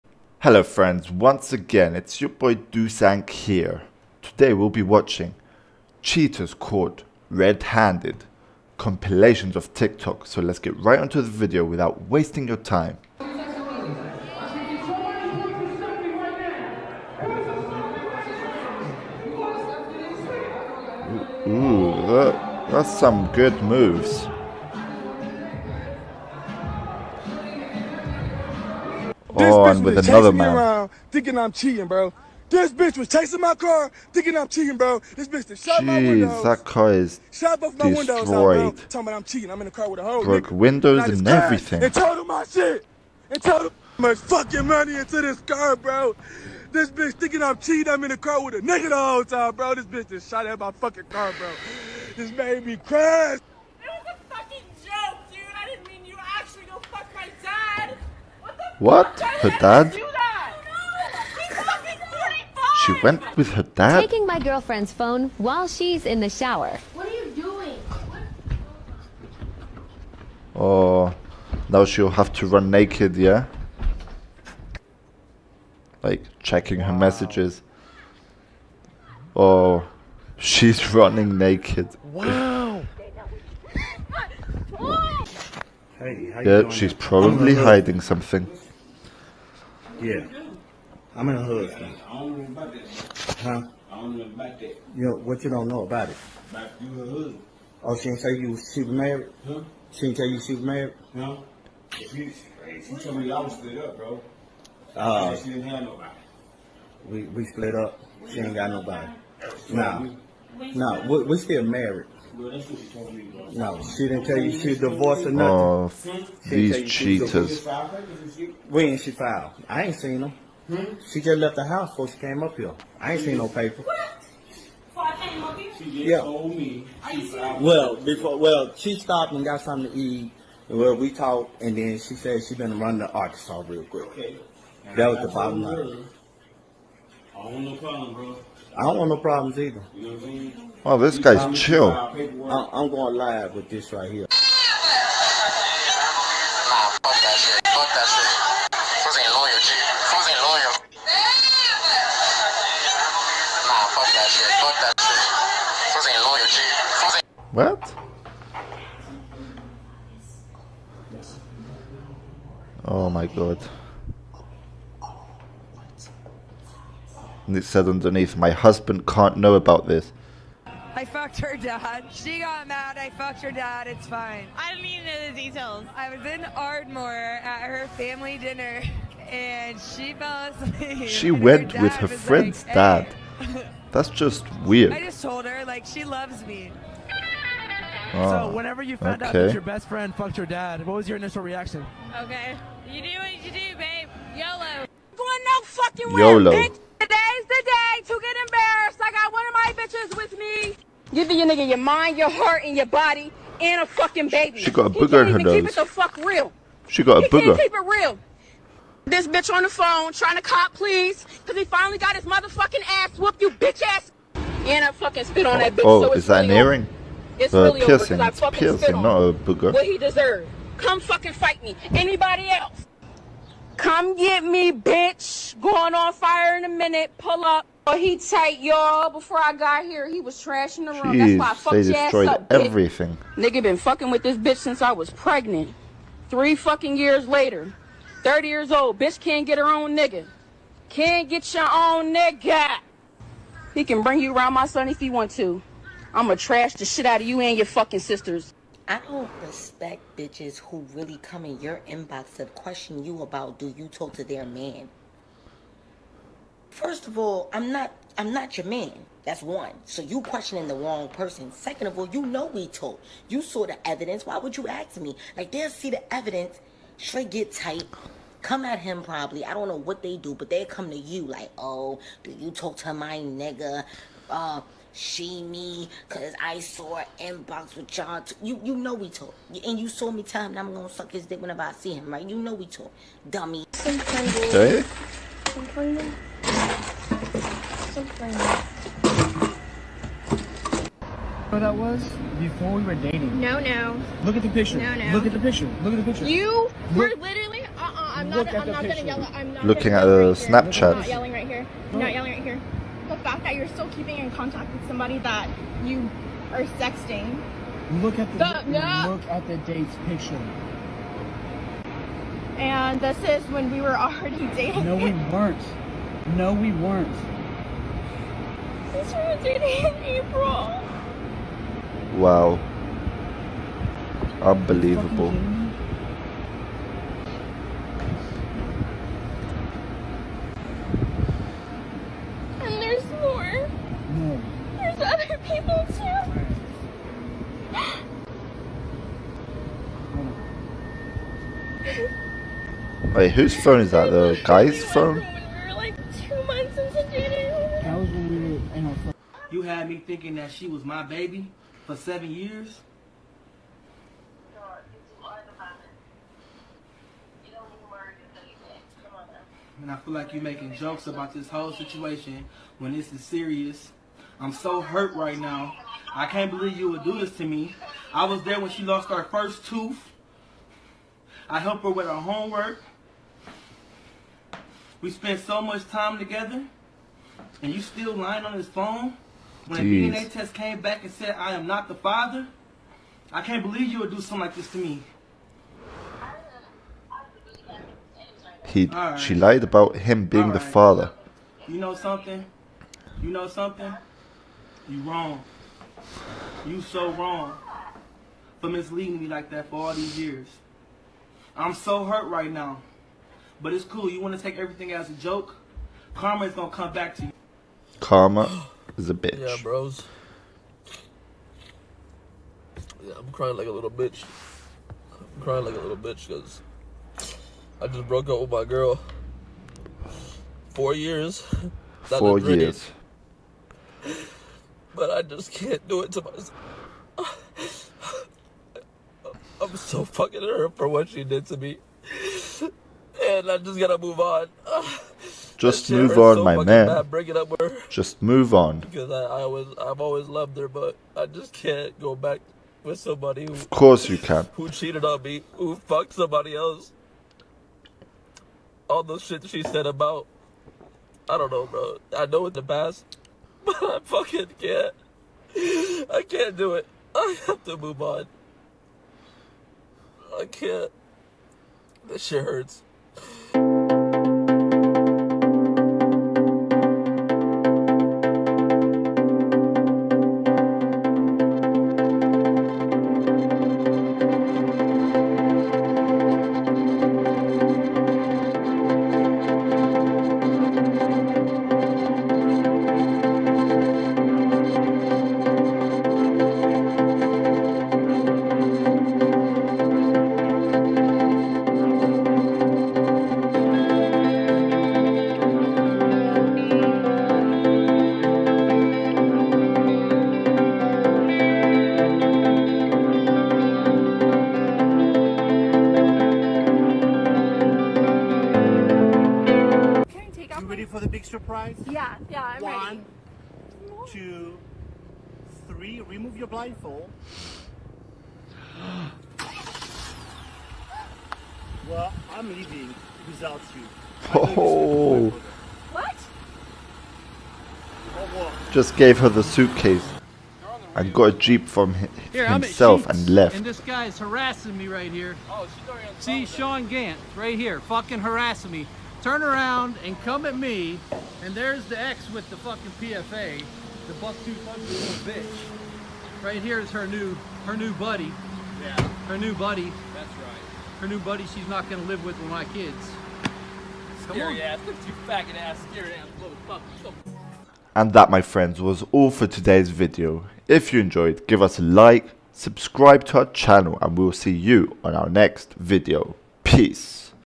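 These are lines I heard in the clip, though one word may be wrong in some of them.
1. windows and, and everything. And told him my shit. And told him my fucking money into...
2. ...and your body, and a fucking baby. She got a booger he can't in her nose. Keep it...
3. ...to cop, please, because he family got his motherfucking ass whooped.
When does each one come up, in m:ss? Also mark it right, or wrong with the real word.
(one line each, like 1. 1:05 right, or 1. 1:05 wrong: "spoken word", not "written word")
1. 0:40 right
2. 3:22 right
3. 3:30 wrong: "finally", not "family".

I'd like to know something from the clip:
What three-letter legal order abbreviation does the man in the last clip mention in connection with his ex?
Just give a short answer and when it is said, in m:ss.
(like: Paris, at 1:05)
PFA, at 9:02.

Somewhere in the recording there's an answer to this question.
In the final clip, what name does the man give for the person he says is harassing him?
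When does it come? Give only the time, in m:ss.
8:56.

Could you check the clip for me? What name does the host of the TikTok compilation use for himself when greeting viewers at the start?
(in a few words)
Dusank.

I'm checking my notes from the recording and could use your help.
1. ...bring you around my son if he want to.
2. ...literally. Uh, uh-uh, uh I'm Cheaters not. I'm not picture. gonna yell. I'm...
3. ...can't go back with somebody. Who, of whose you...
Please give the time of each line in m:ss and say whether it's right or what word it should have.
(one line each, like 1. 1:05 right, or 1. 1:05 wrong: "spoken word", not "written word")
1. 4:04 right
2. 4:57 wrong: "Look", not "Cheaters"
3. 7:21 wrong: "course", not "whose".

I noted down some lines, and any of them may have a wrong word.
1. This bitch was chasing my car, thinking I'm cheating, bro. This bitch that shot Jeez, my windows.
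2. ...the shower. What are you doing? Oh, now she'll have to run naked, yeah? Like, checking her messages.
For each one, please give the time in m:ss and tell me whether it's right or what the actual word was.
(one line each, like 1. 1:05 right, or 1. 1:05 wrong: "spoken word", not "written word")
1. 0:32 right
2. 1:06 right.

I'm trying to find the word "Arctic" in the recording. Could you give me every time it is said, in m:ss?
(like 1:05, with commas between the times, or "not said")
not said.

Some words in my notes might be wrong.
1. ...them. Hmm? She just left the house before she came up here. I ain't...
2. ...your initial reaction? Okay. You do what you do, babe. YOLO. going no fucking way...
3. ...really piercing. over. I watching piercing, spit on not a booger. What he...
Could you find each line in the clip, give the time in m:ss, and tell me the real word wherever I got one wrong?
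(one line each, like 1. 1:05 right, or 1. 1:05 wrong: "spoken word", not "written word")
1. 2:00 right
2. 3:11 right
3. 3:37 wrong: "fucking", not "watching".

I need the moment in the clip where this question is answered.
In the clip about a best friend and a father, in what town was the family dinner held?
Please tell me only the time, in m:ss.
2:56.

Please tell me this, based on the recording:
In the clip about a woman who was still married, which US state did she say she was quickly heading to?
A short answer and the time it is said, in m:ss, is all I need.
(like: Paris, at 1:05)
Arkansas, at 2:13.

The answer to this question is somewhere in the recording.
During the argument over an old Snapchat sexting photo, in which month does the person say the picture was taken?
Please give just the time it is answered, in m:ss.
5:20.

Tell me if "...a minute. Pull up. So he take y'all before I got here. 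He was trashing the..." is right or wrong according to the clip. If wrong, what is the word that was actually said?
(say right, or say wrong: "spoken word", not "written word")
right.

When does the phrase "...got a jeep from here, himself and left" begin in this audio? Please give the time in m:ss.
8:51.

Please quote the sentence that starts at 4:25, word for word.
Like they'll see the evidence, straight get tight, come at him probably.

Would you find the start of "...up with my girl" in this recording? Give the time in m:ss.
6:58.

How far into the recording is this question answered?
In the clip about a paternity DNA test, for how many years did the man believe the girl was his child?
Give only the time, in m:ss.
5:51.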